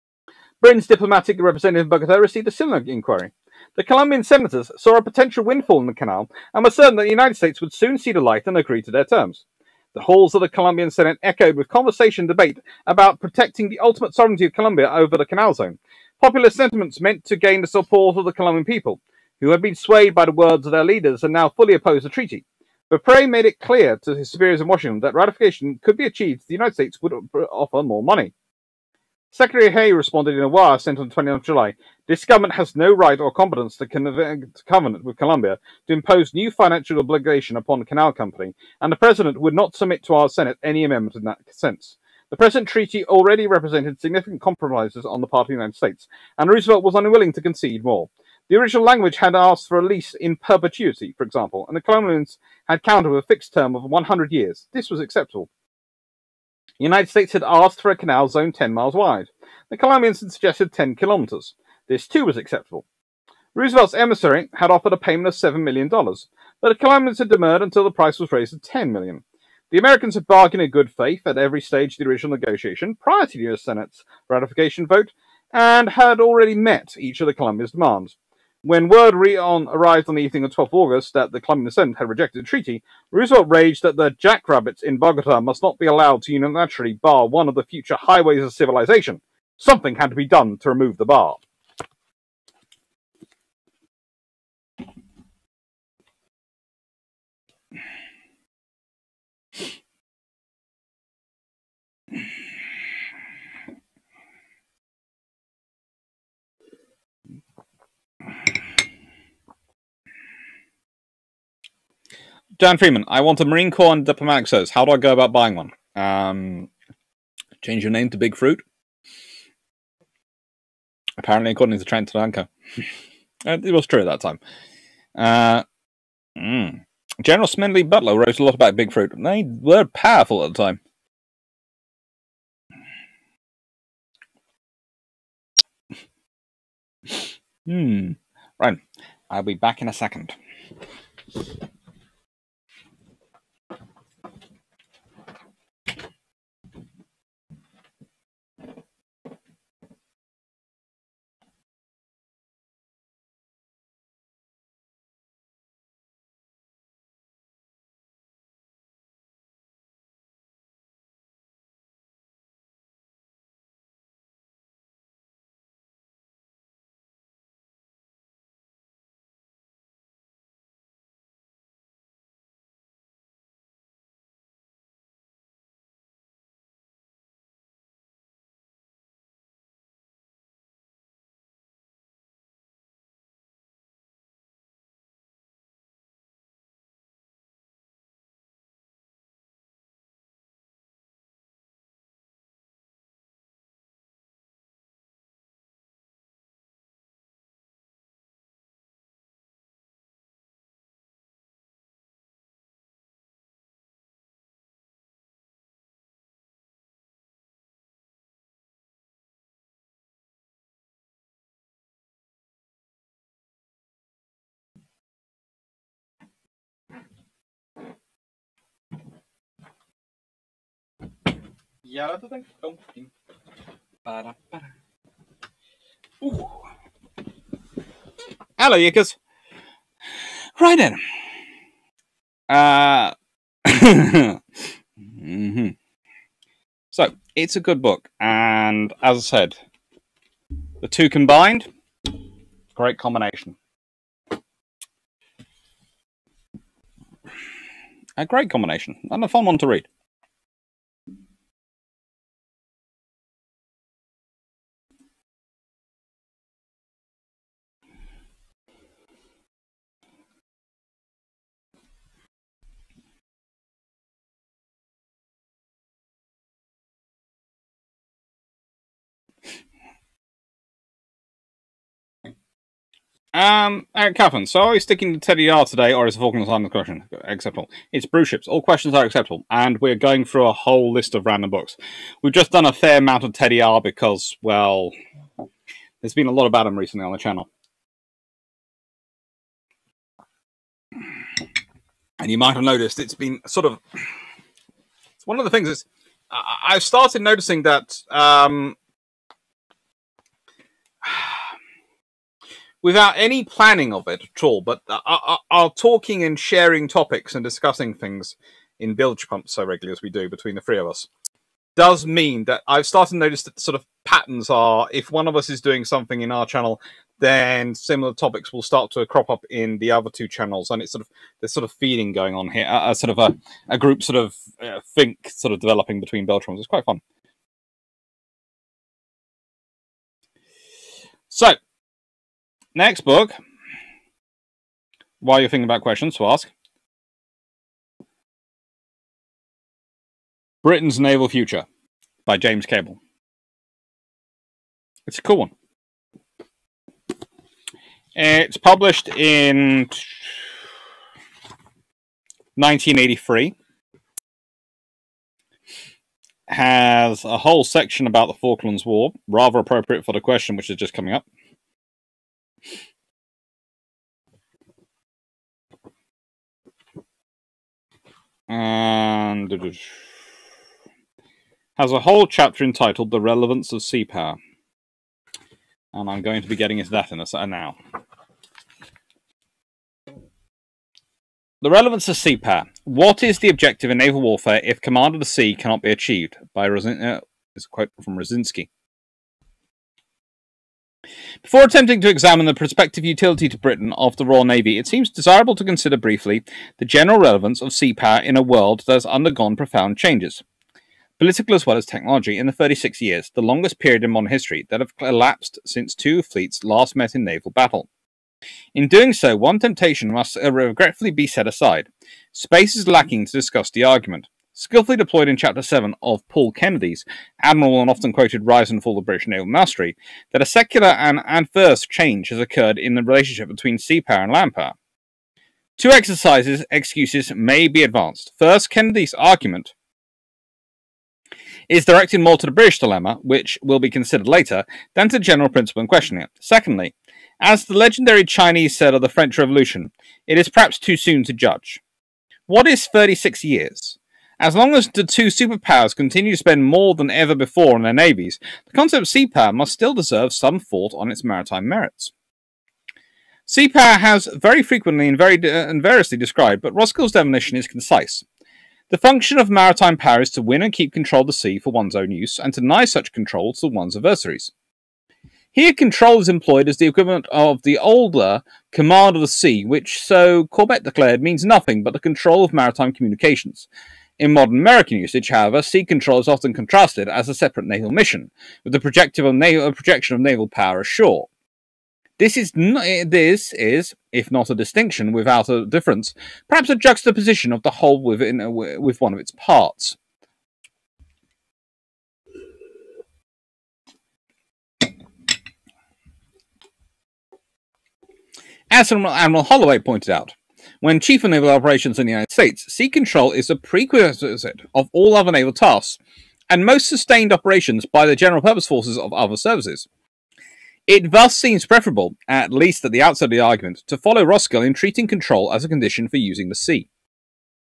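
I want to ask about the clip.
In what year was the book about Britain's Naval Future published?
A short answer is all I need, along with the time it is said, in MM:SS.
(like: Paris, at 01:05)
1983, at 05:52.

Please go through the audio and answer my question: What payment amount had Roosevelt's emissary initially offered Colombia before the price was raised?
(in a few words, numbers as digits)
$7 million.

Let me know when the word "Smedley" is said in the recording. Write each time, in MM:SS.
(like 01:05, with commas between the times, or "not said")
02:07.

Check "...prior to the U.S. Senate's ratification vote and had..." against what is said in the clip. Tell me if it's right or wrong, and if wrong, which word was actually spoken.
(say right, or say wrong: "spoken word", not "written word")
right.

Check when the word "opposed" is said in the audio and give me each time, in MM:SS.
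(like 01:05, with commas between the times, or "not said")
00:21.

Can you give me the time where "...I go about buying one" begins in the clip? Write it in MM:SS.
01:54.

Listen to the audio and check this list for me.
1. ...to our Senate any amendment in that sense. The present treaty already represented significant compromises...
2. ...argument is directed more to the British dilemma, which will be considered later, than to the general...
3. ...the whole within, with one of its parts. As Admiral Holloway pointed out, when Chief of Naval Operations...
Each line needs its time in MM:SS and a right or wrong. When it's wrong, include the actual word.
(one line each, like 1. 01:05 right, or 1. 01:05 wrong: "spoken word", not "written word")
1. 00:40 right
2. 07:09 right
3. 08:07 right.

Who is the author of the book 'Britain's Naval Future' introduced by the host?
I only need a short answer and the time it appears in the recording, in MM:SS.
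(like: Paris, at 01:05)
James Cable, at 05:42.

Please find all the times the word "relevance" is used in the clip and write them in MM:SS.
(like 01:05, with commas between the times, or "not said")
06:13, 06:21, 06:37.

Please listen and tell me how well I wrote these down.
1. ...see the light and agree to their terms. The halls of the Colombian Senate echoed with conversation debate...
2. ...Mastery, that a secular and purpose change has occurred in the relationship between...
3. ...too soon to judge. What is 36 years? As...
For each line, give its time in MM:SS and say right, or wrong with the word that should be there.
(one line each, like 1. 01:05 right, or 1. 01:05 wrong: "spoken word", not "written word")
1. 00:07 right
2. 06:59 wrong: "adverse", not "purpose"
3. 07:20 right.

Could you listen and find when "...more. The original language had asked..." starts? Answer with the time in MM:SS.
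00:47.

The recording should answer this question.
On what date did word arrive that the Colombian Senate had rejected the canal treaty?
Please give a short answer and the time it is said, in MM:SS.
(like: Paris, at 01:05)
12 August, at 01:20.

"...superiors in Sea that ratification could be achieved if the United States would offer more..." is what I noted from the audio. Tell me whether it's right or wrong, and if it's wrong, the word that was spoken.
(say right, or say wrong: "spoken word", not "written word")
wrong: "Washington", not "Sea".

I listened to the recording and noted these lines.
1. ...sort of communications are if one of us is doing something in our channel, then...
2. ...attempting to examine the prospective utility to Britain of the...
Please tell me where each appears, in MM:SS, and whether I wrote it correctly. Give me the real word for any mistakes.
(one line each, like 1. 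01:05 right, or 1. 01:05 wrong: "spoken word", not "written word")
1. 05:13 wrong: "patterns", not "communications"
2. 06:31 right.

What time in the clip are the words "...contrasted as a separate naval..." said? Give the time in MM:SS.
07:56.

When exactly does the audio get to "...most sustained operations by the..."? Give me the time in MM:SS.
08:26.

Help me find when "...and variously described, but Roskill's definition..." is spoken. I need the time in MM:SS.
07:35.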